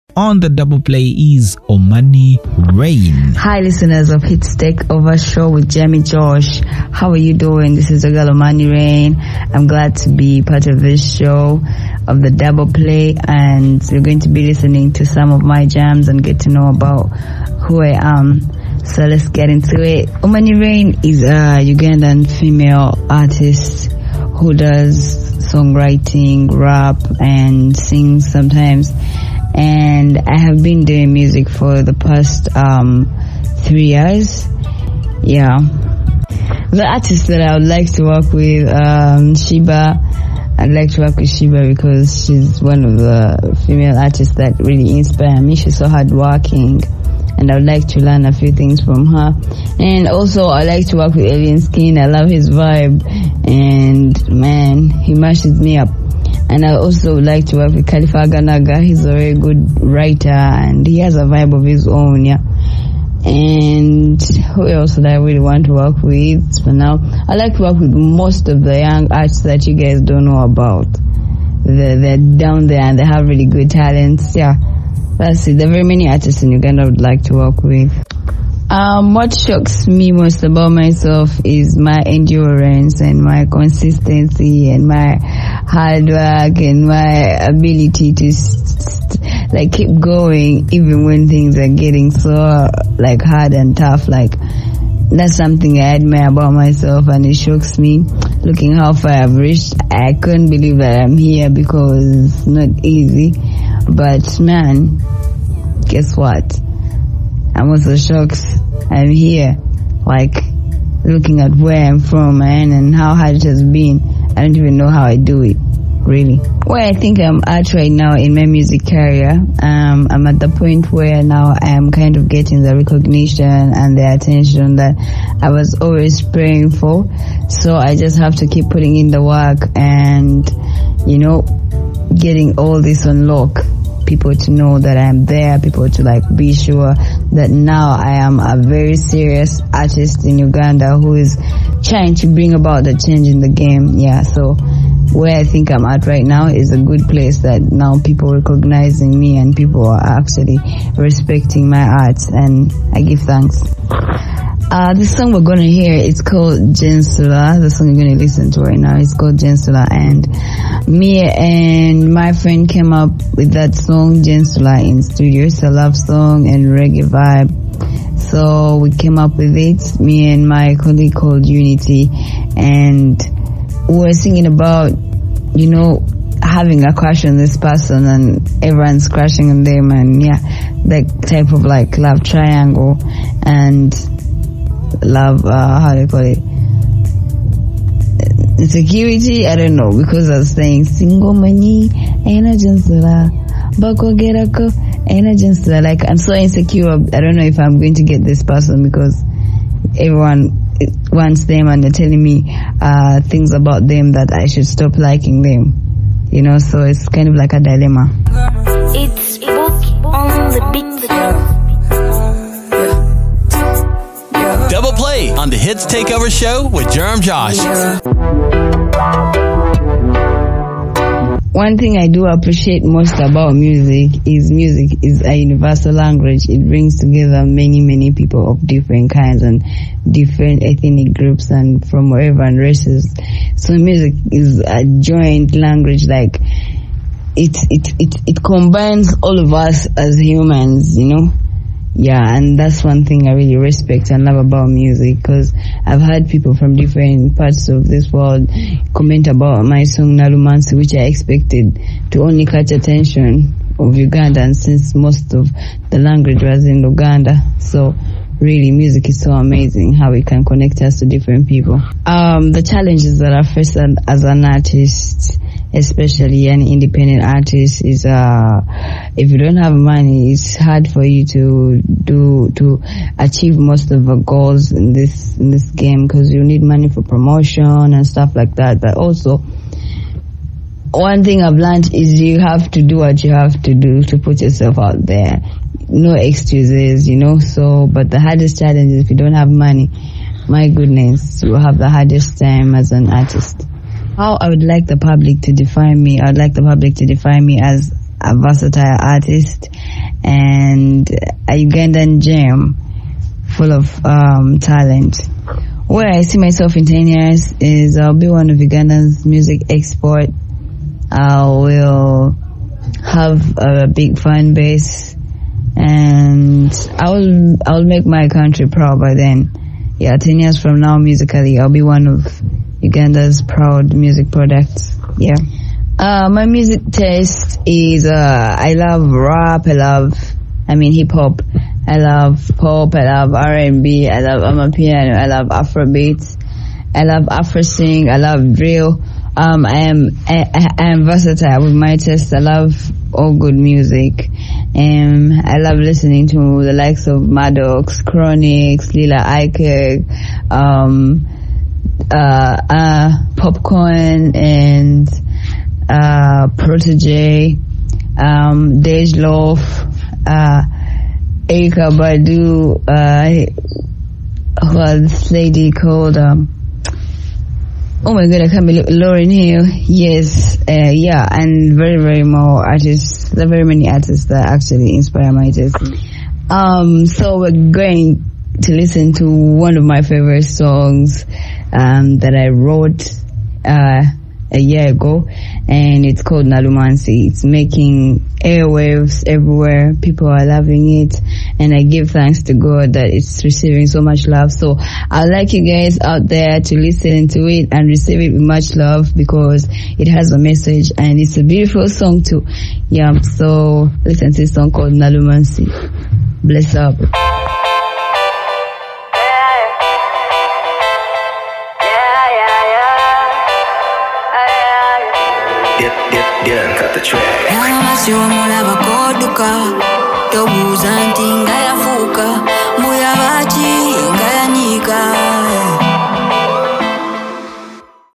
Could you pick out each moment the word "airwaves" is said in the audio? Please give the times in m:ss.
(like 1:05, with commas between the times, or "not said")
6:28.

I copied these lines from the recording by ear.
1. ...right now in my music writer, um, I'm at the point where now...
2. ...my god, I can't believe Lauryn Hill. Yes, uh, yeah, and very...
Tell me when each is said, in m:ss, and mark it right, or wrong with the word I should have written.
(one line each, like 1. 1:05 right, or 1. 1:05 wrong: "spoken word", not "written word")
1. 1:57 wrong: "career", not "writer"
2. 6:08 right.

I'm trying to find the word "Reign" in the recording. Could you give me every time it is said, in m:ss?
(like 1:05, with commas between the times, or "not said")
0:02, 0:08, 0:20.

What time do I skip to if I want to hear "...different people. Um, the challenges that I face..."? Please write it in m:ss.
4:21.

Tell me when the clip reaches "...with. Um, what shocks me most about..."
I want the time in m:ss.
1:17.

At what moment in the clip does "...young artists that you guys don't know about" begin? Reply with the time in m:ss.
1:08.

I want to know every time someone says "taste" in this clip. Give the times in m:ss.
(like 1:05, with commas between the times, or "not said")
5:26, 5:41, 6:15.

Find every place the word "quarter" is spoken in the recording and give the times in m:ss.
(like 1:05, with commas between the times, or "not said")
not said.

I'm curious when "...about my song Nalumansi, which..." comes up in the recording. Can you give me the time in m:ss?
4:09.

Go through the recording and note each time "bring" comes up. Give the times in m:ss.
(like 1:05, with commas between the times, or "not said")
2:22, 3:46.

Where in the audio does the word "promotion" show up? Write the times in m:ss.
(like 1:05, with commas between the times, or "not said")
4:37.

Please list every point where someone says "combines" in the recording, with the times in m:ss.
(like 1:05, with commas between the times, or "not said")
3:58.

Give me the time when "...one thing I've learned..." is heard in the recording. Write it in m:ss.
4:40.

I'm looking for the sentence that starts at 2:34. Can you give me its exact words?
Uh, the song we're gonna hear it's called Jensula.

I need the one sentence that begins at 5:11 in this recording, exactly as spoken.
I will have a big fan base and I'll I'll make my country proud by then.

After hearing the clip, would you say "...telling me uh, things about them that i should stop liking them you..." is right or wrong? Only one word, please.
right.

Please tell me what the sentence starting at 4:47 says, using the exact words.
So, but the hardest challenge is if you don't have money.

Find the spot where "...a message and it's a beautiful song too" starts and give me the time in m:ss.
6:40.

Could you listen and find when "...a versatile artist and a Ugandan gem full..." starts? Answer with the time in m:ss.
4:58.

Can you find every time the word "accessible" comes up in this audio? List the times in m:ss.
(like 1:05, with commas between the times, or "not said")
not said.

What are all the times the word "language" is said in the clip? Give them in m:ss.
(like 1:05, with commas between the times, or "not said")
3:45, 3:55, 4:15.